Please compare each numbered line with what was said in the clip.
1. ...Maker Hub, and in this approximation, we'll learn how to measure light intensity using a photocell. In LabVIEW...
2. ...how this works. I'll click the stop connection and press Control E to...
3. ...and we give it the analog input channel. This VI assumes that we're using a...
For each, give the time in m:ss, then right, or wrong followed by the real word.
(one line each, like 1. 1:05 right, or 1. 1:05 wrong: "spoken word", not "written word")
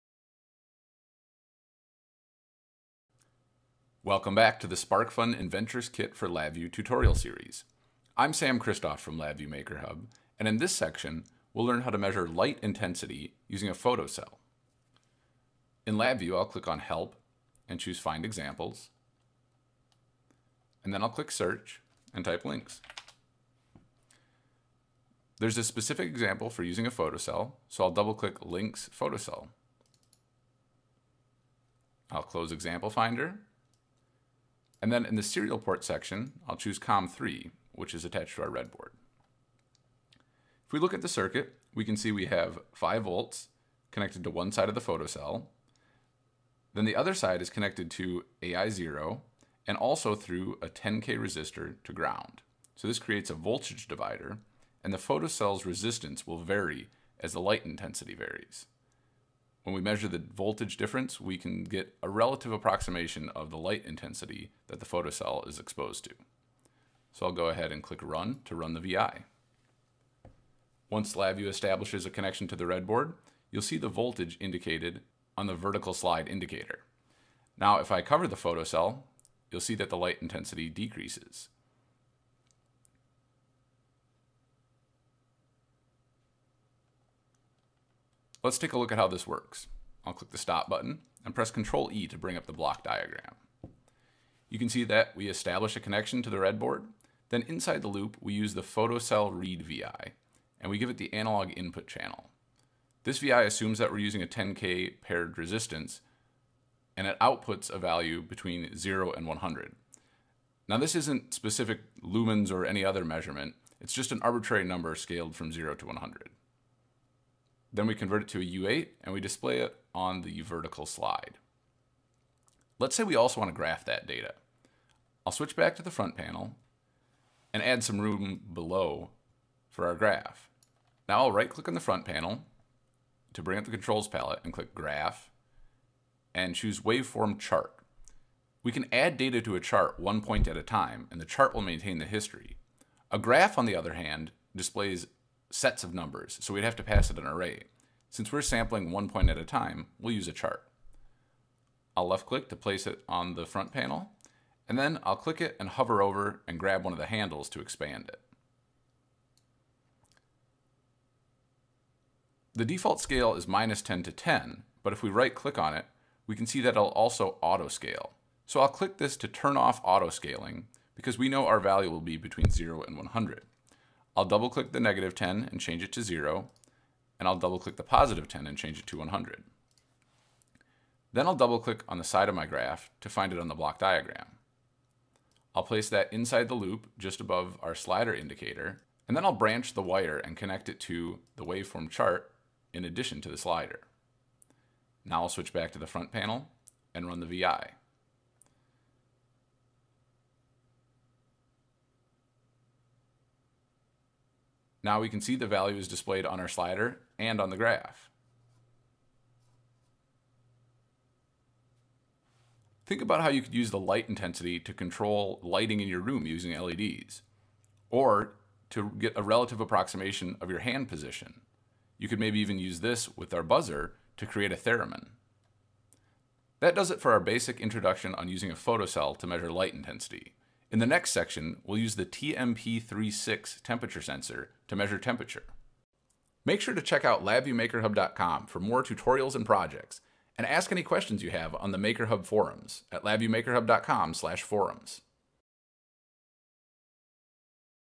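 1. 0:09 wrong: "section", not "approximation"
2. 1:28 wrong: "button", not "connection"
3. 1:40 right.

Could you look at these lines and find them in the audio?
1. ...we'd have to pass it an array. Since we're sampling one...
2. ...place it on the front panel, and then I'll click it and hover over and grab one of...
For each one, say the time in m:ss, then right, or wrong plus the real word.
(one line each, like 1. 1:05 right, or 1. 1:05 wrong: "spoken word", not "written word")
1. 2:26 right
2. 2:32 right.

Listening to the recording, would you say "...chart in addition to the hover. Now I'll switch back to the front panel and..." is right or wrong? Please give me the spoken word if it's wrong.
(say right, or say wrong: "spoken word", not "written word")
wrong: "slider", not "hover".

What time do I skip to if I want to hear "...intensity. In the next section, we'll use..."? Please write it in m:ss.
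3:49.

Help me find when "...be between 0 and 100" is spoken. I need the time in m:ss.
2:52.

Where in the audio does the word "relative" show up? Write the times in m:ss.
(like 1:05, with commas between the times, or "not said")
1:02, 3:39.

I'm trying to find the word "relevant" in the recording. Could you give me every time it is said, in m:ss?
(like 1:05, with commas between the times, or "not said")
not said.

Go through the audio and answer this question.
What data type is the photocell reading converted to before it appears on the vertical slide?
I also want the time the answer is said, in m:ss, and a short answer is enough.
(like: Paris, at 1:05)
U8, at 1:58.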